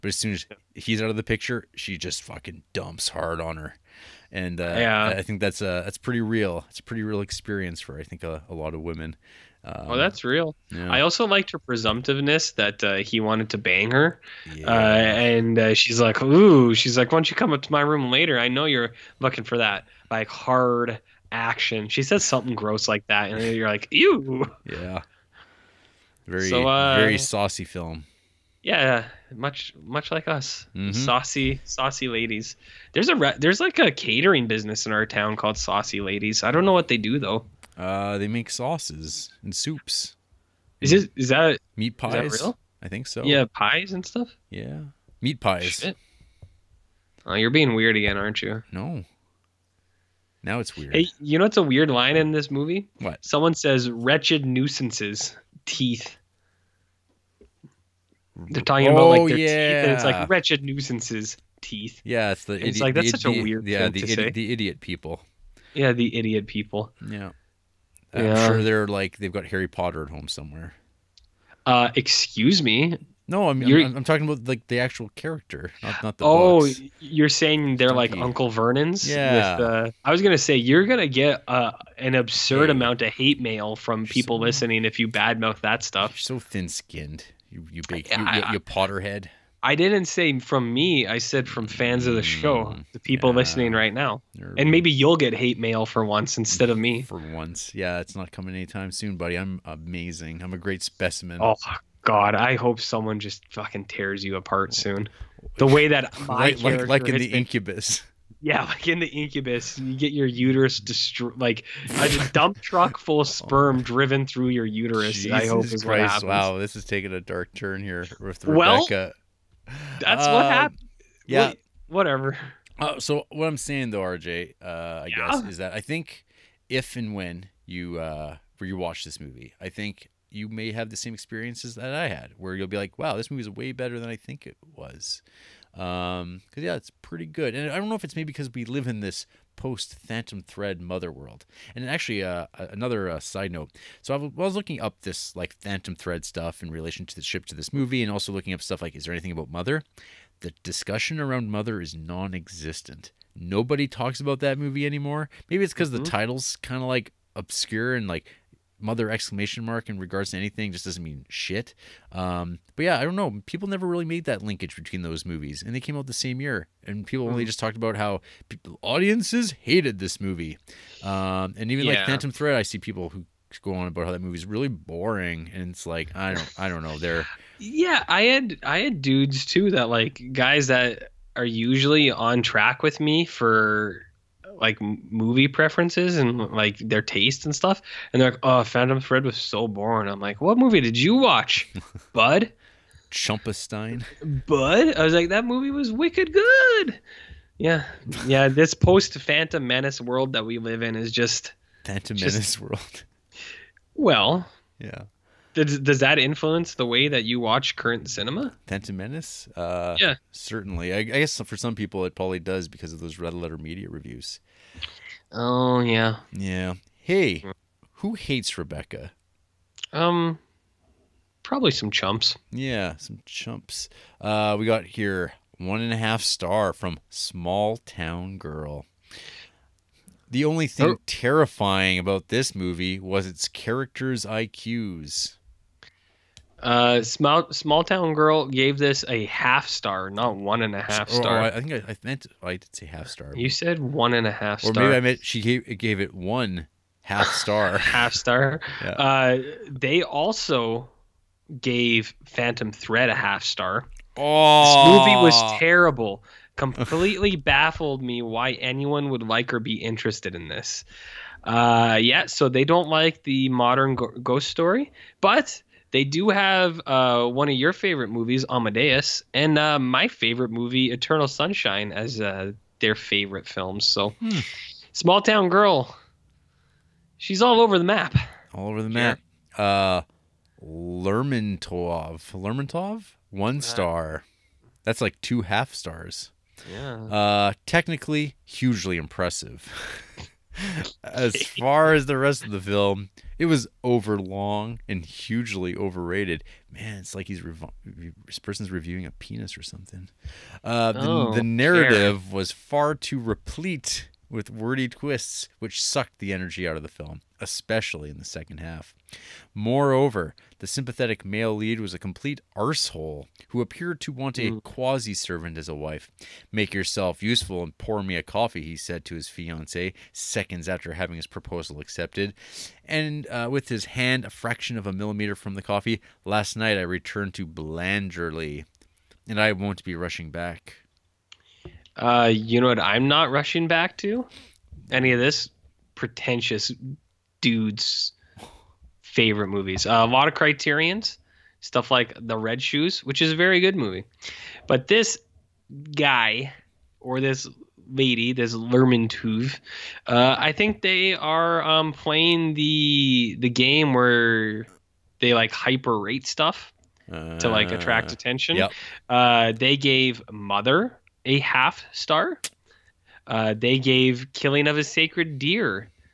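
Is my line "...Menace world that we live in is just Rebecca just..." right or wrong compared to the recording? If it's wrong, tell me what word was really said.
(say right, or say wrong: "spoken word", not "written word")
wrong: "Phantom", not "Rebecca".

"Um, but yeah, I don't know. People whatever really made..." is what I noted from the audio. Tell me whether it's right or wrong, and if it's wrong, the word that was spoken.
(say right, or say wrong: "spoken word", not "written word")
wrong: "never", not "whatever".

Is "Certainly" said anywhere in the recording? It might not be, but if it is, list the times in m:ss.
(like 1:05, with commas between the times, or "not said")
3:30.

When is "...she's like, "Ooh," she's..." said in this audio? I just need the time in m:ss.
0:15.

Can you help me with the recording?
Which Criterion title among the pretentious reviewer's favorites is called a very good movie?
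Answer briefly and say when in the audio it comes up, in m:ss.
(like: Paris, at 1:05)
The Red Shoes, at 5:42.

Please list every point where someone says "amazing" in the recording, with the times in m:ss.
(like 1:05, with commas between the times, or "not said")
1:39.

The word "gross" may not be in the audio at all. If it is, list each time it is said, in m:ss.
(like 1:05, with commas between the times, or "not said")
0:22.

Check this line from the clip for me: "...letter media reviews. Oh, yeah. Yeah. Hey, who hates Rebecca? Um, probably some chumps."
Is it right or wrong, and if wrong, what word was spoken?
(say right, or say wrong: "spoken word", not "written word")
right.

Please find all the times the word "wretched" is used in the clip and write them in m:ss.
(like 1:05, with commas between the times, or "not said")
0:53, 1:00.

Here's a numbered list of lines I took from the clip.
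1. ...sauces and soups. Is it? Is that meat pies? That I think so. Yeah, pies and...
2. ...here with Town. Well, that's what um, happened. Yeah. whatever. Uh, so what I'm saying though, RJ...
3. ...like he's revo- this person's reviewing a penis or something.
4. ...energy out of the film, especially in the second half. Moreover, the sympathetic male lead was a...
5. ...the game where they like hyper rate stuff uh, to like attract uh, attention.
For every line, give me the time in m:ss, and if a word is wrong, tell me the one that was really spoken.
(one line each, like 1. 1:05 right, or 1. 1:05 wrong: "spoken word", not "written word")
1. 0:38 right
2. 1:57 wrong: "Rebecca", not "Town"
3. 4:57 right
4. 5:06 right
5. 5:53 right.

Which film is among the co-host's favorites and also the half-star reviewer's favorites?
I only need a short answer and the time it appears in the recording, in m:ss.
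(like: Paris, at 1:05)
Eternal Sunshine, at 4:30.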